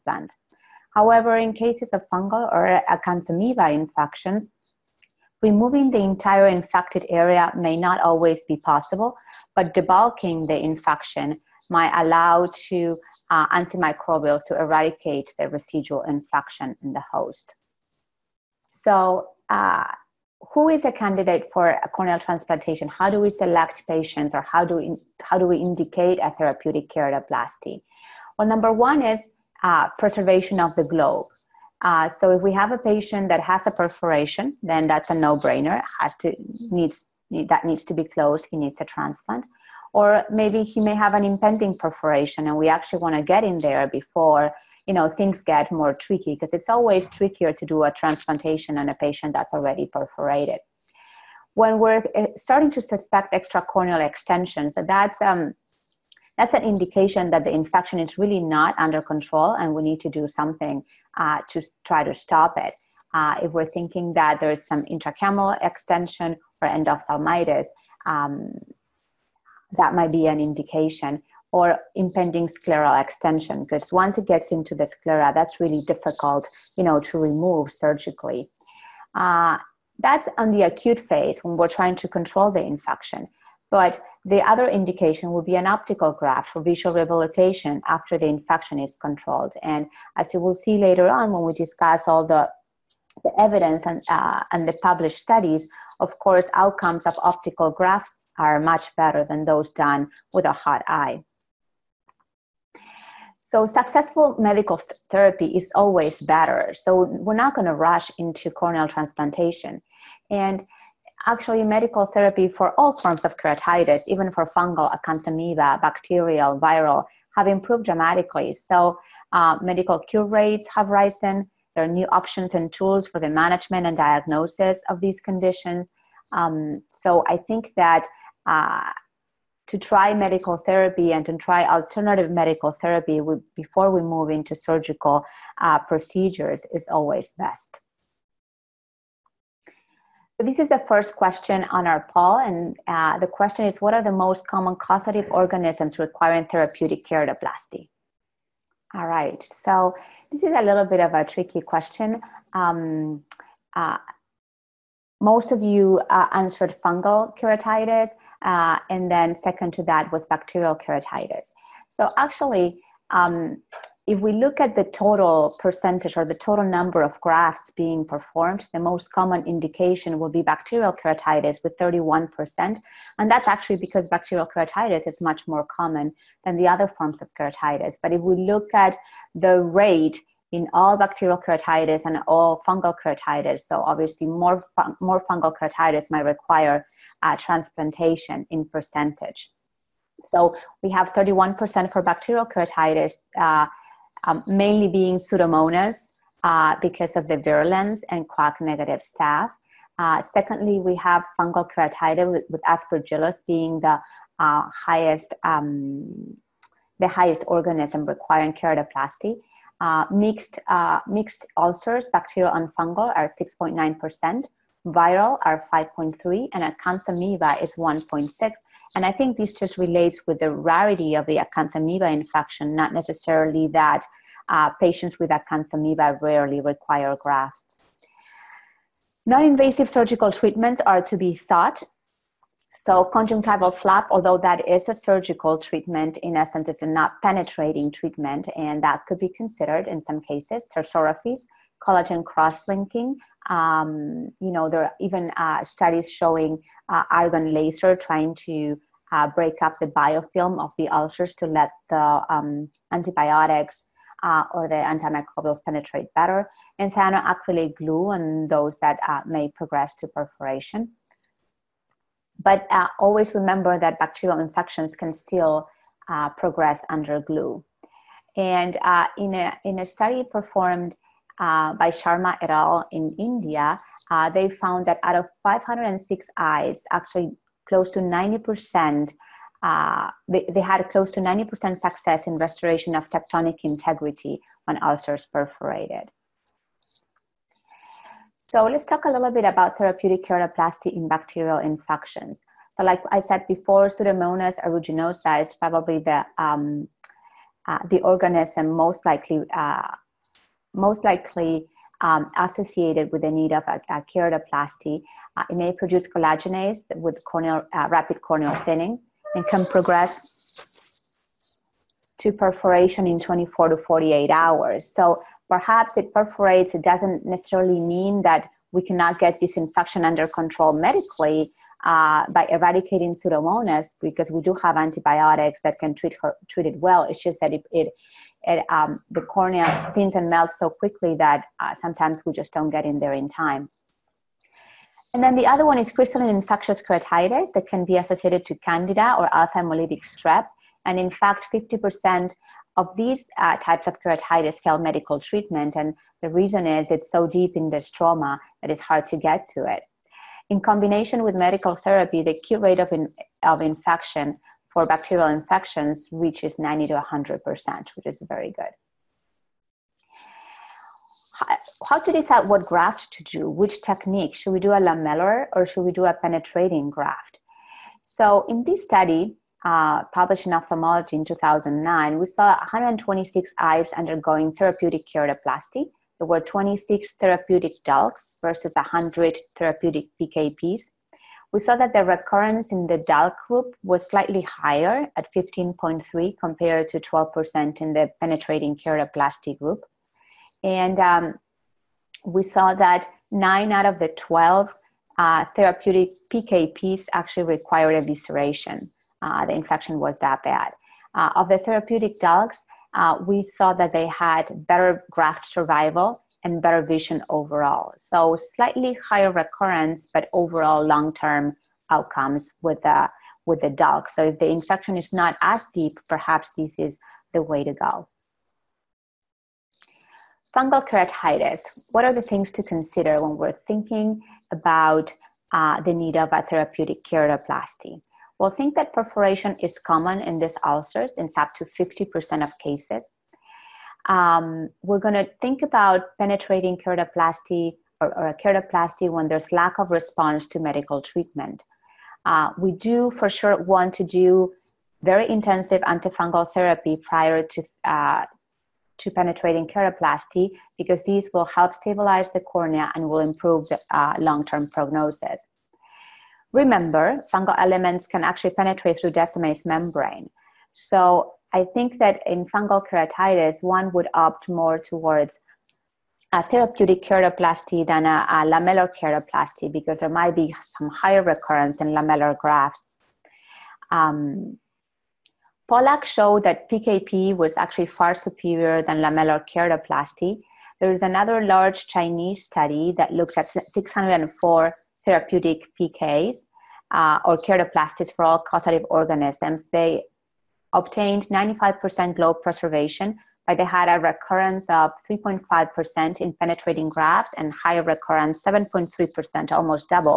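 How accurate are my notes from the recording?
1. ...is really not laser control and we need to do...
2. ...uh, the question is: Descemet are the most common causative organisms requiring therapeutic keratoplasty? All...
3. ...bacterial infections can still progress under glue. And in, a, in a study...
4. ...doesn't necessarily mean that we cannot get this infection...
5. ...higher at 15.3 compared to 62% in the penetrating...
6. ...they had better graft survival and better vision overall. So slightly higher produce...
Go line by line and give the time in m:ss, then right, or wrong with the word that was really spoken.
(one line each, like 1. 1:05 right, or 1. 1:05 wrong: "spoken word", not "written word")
1. 0:57 wrong: "under", not "laser"
2. 2:22 wrong: "What", not "Descemet"
3. 4:23 right
4. 5:16 right
5. 6:24 wrong: "12", not "62"
6. 6:43 wrong: "recurrence", not "produce".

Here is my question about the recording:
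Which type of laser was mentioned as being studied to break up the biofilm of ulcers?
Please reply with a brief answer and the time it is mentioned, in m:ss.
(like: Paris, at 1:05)
Argon laser, at 4:07.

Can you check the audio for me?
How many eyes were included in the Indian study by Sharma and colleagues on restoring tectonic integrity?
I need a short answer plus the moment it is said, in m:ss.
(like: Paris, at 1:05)
506, at 4:35.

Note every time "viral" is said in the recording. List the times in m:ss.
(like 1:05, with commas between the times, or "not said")
1:56, 3:34.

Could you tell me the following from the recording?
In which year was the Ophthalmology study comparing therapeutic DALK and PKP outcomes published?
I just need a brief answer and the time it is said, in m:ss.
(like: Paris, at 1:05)
2009, at 6:11.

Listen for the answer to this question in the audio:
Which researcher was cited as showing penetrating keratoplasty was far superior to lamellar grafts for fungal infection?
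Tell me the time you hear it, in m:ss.
7:55.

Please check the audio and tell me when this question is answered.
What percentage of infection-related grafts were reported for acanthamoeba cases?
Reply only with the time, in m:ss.
3:37.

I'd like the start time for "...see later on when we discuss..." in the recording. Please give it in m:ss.
1:30.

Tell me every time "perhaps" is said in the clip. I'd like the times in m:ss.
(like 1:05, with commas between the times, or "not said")
5:15, 6:56.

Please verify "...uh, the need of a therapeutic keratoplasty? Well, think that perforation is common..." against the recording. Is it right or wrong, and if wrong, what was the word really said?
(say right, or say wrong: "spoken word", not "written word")
right.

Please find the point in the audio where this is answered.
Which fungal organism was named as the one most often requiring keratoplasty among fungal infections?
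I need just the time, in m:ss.
3:22.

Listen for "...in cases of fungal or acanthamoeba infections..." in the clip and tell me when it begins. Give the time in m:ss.
0:01.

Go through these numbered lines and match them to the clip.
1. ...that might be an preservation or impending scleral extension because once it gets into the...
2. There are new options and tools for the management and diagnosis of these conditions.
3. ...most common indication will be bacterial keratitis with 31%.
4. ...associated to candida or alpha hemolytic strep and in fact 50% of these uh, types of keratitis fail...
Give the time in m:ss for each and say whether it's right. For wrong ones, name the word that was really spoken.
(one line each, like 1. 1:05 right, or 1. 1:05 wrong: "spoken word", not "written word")
1. 1:09 wrong: "indication", not "preservation"
2. 2:01 right
3. 2:48 right
4. 5:37 right.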